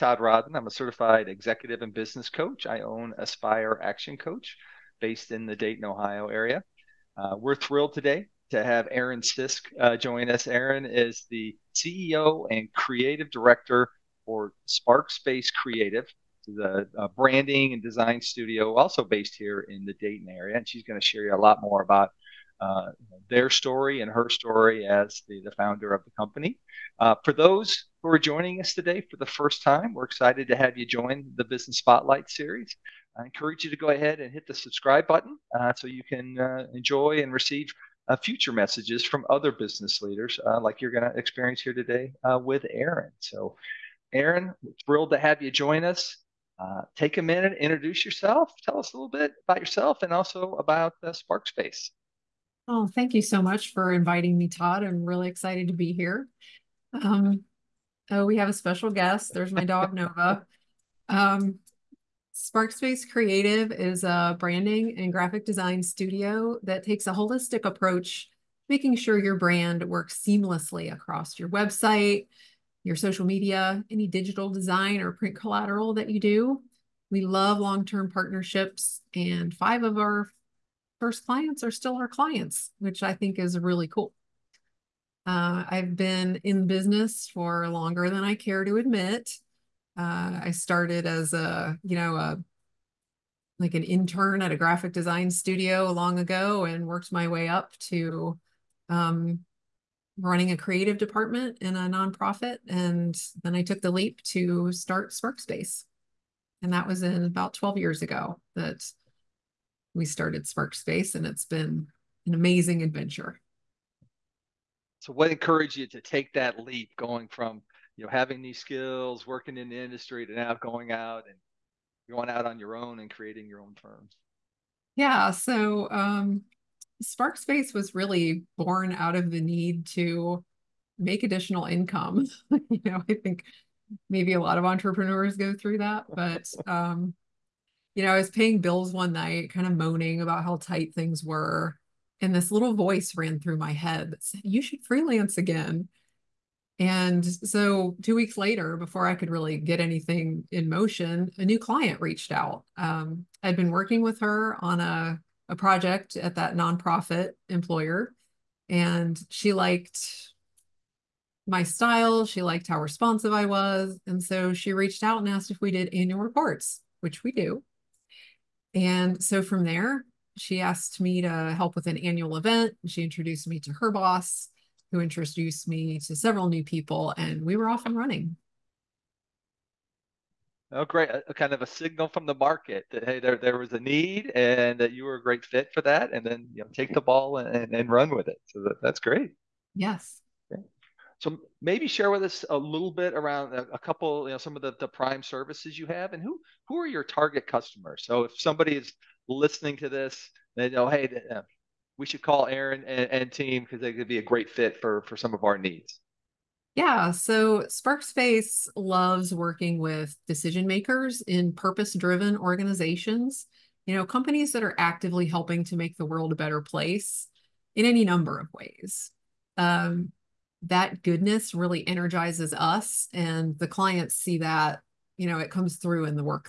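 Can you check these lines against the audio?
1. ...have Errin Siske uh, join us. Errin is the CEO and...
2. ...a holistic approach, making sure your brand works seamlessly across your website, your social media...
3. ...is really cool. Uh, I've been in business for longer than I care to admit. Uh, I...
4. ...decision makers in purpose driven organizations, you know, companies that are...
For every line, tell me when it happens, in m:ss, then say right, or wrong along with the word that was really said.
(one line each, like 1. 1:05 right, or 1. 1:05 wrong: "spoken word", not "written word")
1. 0:08 right
2. 1:07 right
3. 1:23 right
4. 3:30 right.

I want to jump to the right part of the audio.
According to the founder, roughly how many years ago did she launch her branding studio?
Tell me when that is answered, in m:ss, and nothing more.
1:47.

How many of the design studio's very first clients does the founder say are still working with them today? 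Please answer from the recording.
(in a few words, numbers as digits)
5.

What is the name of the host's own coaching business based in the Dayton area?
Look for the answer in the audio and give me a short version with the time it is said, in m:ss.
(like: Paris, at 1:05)
Aspire Action Coach, at 0:03.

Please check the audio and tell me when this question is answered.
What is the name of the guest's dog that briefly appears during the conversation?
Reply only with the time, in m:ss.
0:59.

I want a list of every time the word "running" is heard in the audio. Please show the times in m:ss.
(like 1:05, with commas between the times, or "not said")
1:40, 2:57.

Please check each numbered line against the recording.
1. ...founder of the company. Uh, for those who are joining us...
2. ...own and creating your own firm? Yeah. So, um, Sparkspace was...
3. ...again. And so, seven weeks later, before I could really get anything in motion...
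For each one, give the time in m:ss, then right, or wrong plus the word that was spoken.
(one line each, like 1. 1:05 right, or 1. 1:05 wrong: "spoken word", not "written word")
1. 0:25 right
2. 2:02 right
3. 2:25 wrong: "two", not "seven".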